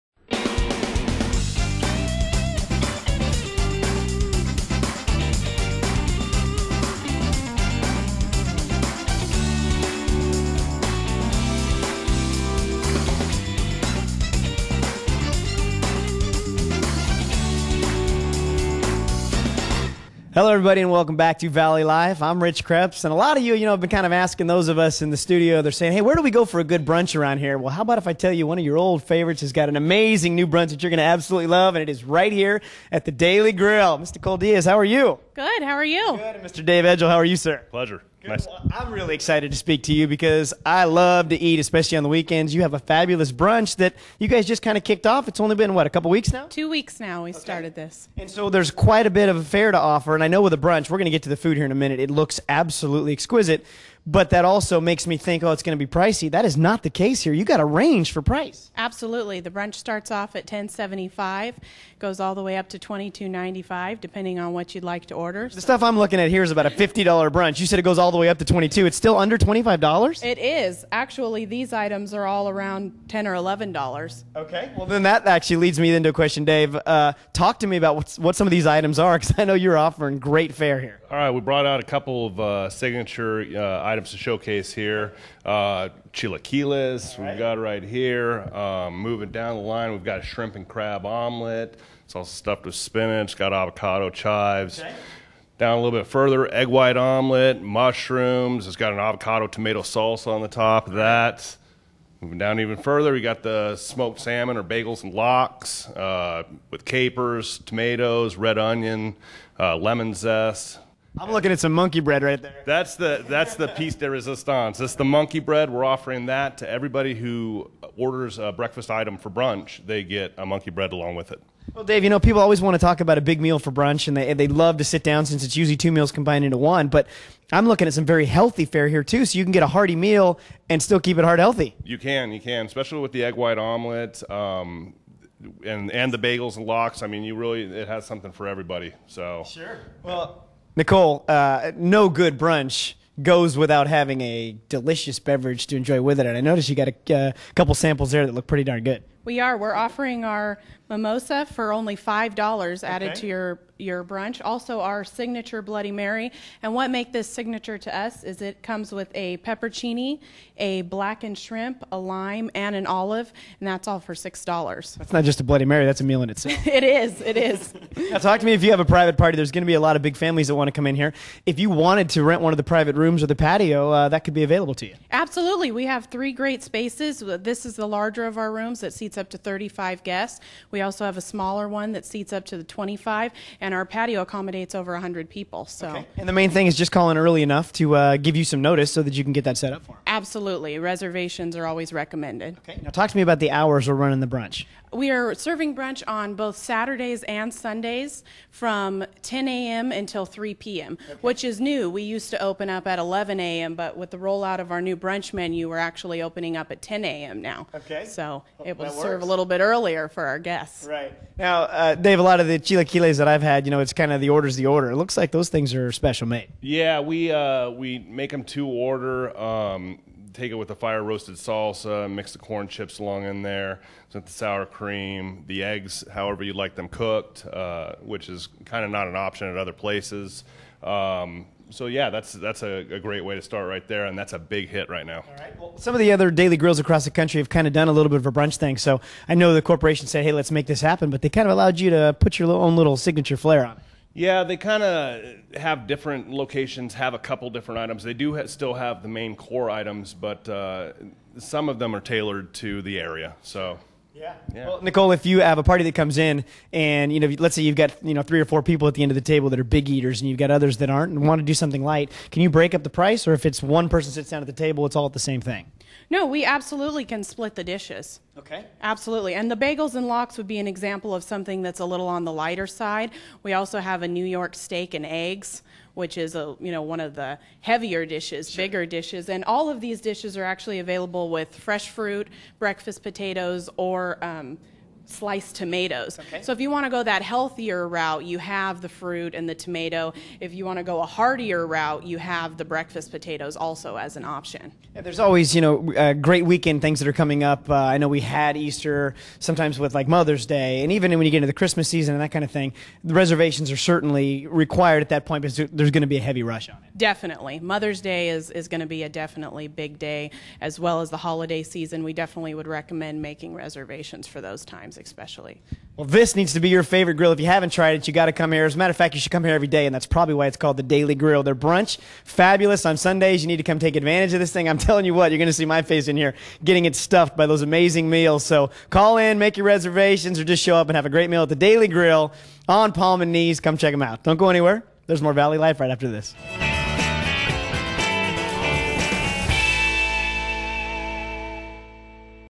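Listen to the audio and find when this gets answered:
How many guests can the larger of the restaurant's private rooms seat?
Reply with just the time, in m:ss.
2:59.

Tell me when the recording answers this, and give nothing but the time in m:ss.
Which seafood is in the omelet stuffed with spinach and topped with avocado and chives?
1:30.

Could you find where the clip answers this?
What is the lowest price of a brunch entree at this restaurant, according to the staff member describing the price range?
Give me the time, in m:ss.
1:00.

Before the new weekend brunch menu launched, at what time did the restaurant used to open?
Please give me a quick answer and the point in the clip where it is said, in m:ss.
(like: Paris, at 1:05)
11 a.m., at 3:22.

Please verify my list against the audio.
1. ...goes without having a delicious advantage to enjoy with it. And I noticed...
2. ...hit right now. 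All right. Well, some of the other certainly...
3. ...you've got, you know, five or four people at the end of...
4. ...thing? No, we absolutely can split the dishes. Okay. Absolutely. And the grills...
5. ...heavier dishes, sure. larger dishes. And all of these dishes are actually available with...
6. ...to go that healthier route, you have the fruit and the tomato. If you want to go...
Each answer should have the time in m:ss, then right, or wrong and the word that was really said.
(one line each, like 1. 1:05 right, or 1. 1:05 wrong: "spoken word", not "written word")
1. 2:23 wrong: "beverage", not "advantage"
2. 3:54 wrong: "daily", not "certainly"
3. 4:17 wrong: "three", not "five"
4. 4:25 wrong: "bagels", not "grills"
5. 4:37 wrong: "bigger", not "larger"
6. 4:46 right.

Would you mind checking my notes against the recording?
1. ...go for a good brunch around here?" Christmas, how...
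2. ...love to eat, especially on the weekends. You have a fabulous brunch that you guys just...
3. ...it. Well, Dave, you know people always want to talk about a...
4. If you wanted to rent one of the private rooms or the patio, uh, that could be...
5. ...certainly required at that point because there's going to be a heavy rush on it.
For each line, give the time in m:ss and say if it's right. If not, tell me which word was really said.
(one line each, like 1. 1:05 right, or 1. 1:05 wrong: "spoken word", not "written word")
1. 0:26 wrong: "Well", not "Christmas"
2. 0:40 right
3. 2:01 right
4. 2:51 right
5. 5:03 right.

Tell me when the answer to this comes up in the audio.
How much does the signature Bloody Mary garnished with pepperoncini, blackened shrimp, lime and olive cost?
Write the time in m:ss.
2:44.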